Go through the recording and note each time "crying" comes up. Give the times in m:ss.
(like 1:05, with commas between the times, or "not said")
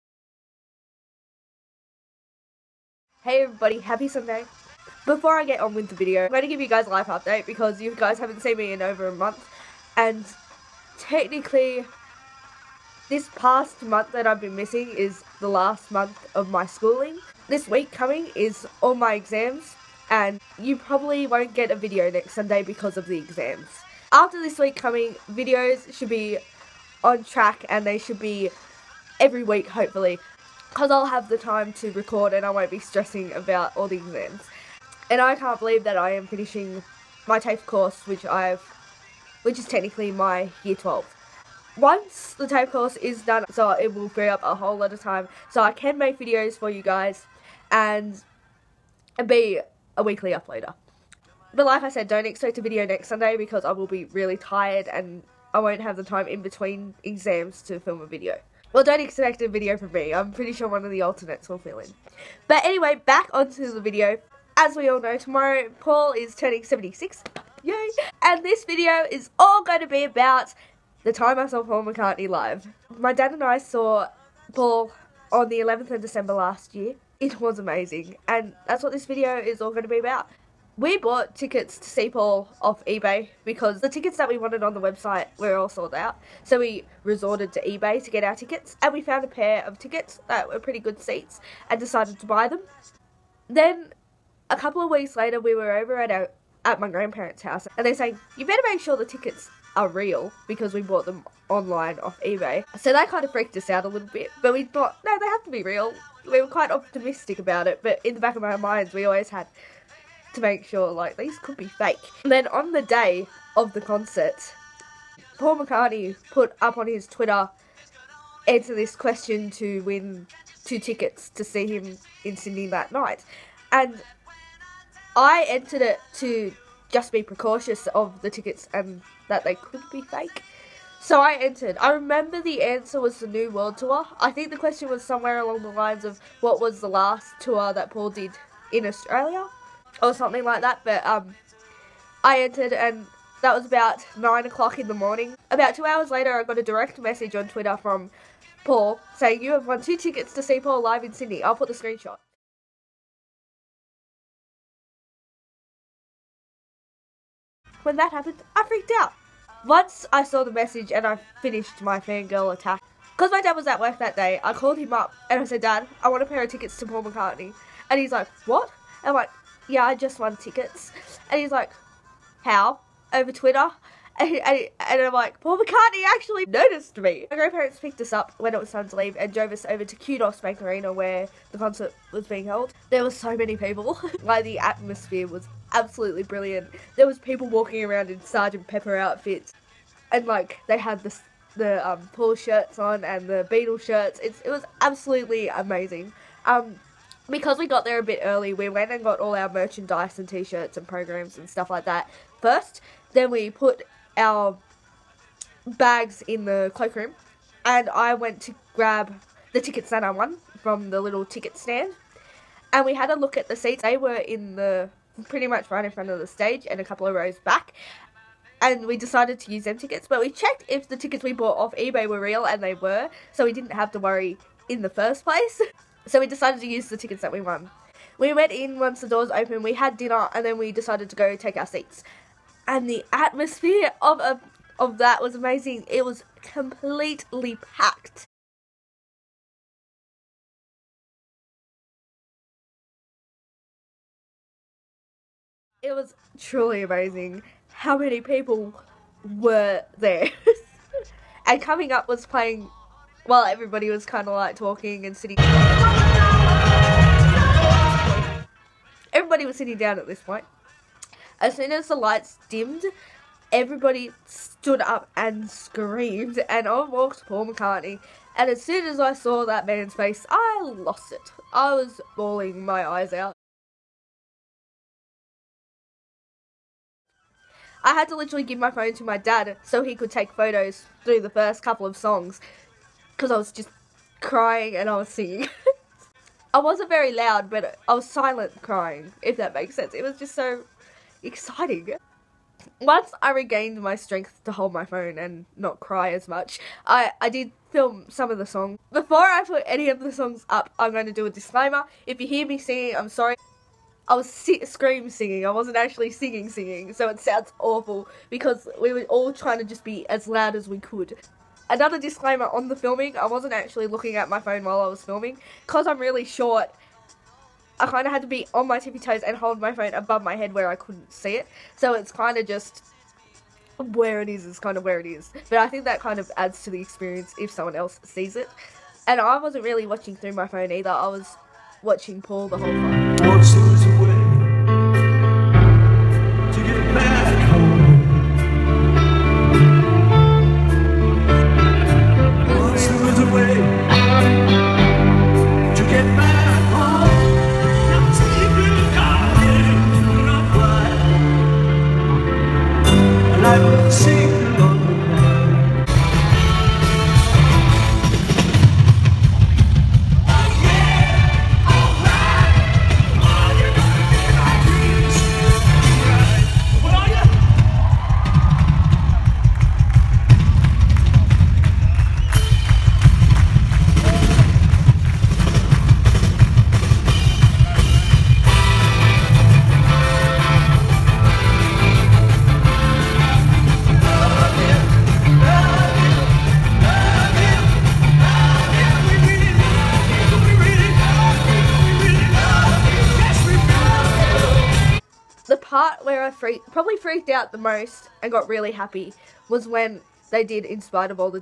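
4:44, 4:48.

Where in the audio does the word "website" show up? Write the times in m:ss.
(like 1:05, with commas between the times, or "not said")
1:24.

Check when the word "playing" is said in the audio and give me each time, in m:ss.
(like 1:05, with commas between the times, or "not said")
4:12.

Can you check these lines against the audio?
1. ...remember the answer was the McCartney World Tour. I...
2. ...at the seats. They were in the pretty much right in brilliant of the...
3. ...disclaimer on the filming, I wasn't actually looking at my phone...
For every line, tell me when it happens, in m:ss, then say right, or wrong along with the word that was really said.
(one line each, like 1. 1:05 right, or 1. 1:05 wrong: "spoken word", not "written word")
1. 2:11 wrong: "New", not "McCartney"
2. 3:33 wrong: "front", not "brilliant"
3. 5:11 right.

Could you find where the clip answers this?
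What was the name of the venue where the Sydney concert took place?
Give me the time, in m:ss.
2:59.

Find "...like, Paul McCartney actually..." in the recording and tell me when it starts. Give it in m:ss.
2:55.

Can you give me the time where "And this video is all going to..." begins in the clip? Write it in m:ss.
1:08.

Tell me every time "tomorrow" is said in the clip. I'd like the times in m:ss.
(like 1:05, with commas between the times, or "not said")
1:05.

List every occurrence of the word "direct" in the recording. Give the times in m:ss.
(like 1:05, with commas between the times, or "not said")
2:26.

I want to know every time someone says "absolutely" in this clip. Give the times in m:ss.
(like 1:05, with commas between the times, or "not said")
3:05, 3:14.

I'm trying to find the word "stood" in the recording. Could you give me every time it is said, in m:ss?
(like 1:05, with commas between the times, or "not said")
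4:24.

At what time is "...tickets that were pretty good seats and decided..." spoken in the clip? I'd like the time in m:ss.
1:29.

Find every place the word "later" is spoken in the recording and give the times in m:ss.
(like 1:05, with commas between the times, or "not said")
1:35, 2:26.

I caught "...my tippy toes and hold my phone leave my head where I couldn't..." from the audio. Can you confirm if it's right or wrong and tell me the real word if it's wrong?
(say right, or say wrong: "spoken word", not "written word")
wrong: "above", not "leave".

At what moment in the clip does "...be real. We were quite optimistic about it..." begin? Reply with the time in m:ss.
1:45.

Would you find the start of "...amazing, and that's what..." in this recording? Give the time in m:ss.
1:17.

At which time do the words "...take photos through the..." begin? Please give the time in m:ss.
4:40.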